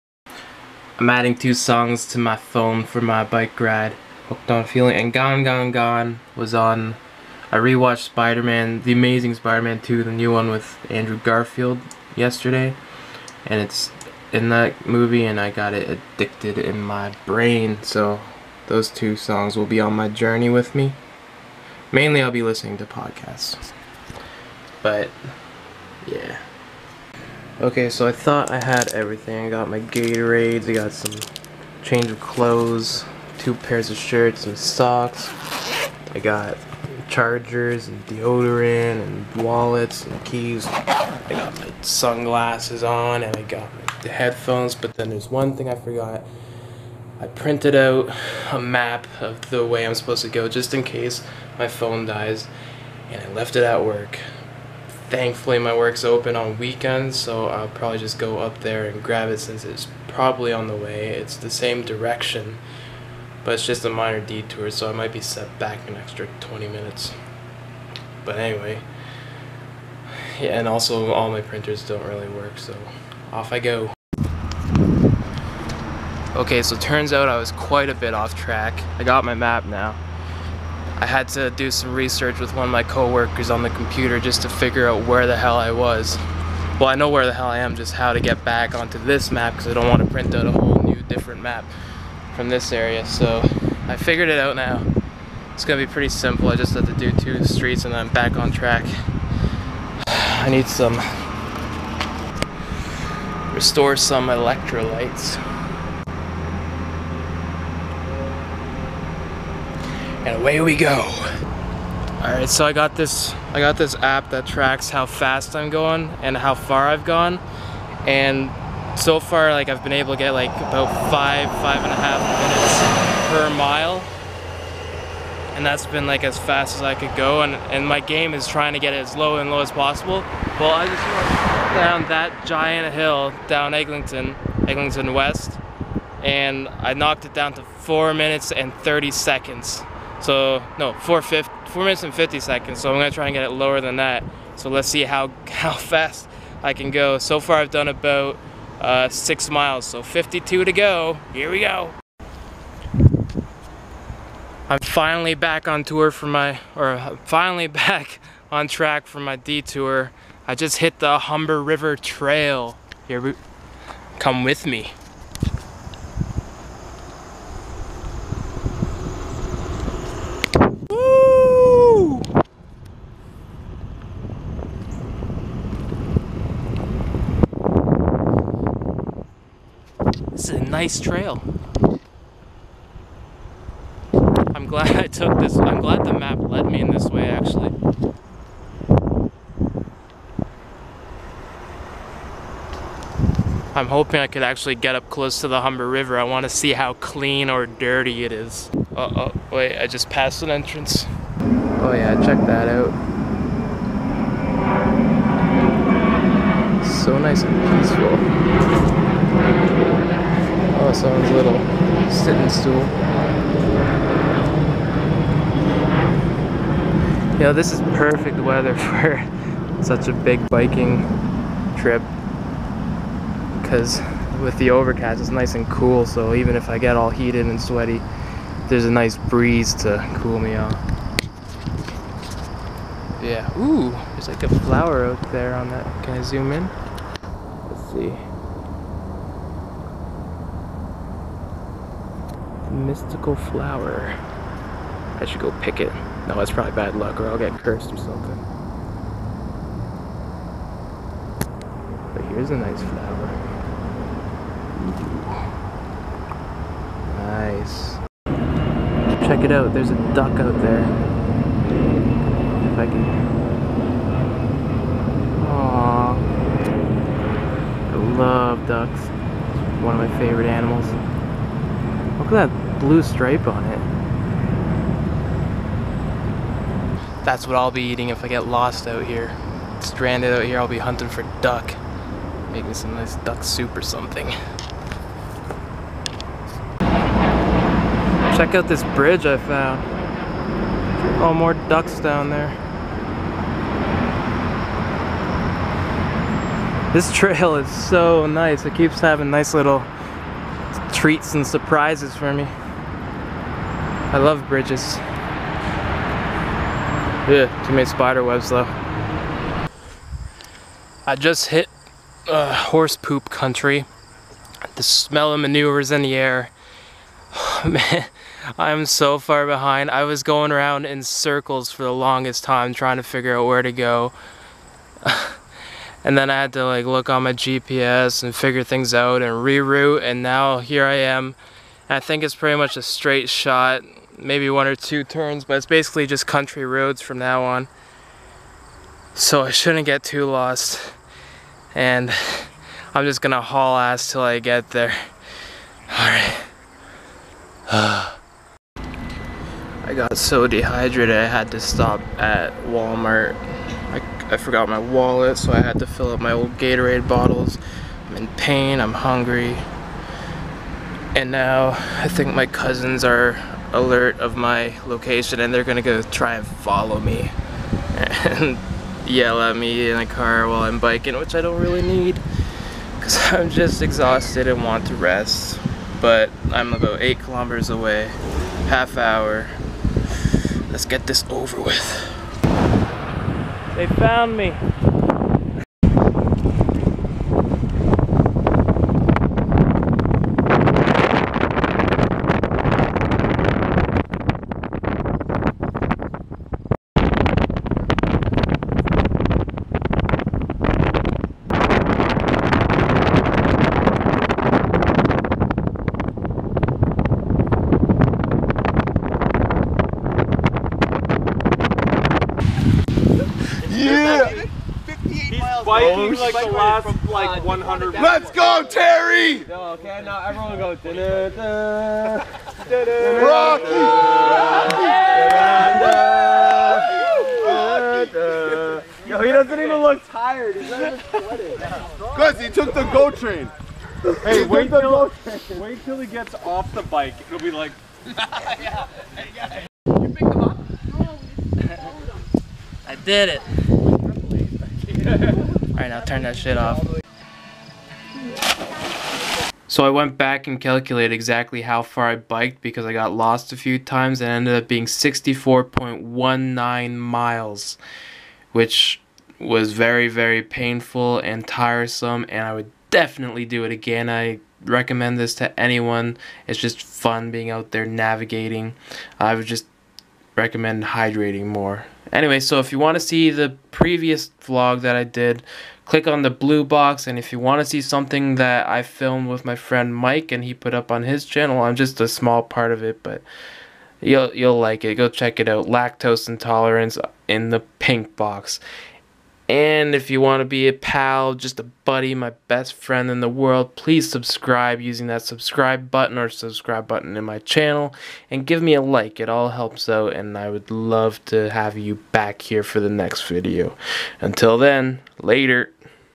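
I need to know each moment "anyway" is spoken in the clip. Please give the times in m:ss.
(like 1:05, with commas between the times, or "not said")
1:08, 7:52.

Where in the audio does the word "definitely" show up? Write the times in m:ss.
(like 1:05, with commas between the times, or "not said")
7:42.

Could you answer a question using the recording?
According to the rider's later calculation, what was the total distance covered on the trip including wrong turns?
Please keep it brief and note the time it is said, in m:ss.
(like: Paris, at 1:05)
64.19 miles, at 7:34.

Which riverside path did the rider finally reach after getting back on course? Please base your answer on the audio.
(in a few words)
Humber River Trail.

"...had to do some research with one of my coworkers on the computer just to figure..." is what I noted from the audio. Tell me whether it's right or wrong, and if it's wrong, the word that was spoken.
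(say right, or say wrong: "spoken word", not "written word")
right.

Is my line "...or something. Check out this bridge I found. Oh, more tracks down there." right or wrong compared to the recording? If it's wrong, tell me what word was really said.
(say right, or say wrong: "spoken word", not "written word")
wrong: "ducks", not "tracks".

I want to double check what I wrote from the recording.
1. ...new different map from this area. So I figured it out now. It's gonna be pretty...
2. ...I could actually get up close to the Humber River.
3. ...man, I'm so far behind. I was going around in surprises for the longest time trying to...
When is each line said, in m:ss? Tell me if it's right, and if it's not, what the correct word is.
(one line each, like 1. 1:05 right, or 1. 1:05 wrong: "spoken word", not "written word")
1. 1:30 right
2. 3:14 right
3. 5:17 wrong: "circles", not "surprises".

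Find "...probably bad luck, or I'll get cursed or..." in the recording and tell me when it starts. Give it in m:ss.
4:06.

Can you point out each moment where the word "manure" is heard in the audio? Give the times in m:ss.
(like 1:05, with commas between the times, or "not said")
5:15.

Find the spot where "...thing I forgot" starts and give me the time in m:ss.
0:45.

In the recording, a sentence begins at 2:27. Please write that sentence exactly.
So far I've done about uh, six miles.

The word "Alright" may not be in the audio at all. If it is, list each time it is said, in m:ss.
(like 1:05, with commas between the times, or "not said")
5:45, 7:25.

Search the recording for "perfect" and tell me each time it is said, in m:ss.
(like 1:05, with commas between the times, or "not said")
3:37.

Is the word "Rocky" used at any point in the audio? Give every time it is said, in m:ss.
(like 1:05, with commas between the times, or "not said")
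7:03, 7:08.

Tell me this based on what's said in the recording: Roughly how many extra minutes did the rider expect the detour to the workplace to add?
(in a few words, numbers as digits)
20.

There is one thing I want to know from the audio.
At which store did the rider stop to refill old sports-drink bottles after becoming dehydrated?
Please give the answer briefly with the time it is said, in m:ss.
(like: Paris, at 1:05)
Walmart, at 5:52.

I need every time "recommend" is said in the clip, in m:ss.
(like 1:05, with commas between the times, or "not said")
7:44, 7:50.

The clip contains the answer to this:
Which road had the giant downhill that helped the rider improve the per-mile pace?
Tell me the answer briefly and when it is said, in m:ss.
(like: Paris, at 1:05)
Eglinton West, at 2:14.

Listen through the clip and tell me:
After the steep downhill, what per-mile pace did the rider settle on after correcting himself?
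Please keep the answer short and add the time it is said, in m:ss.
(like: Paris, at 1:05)
4 minutes 50 seconds, at 2:20.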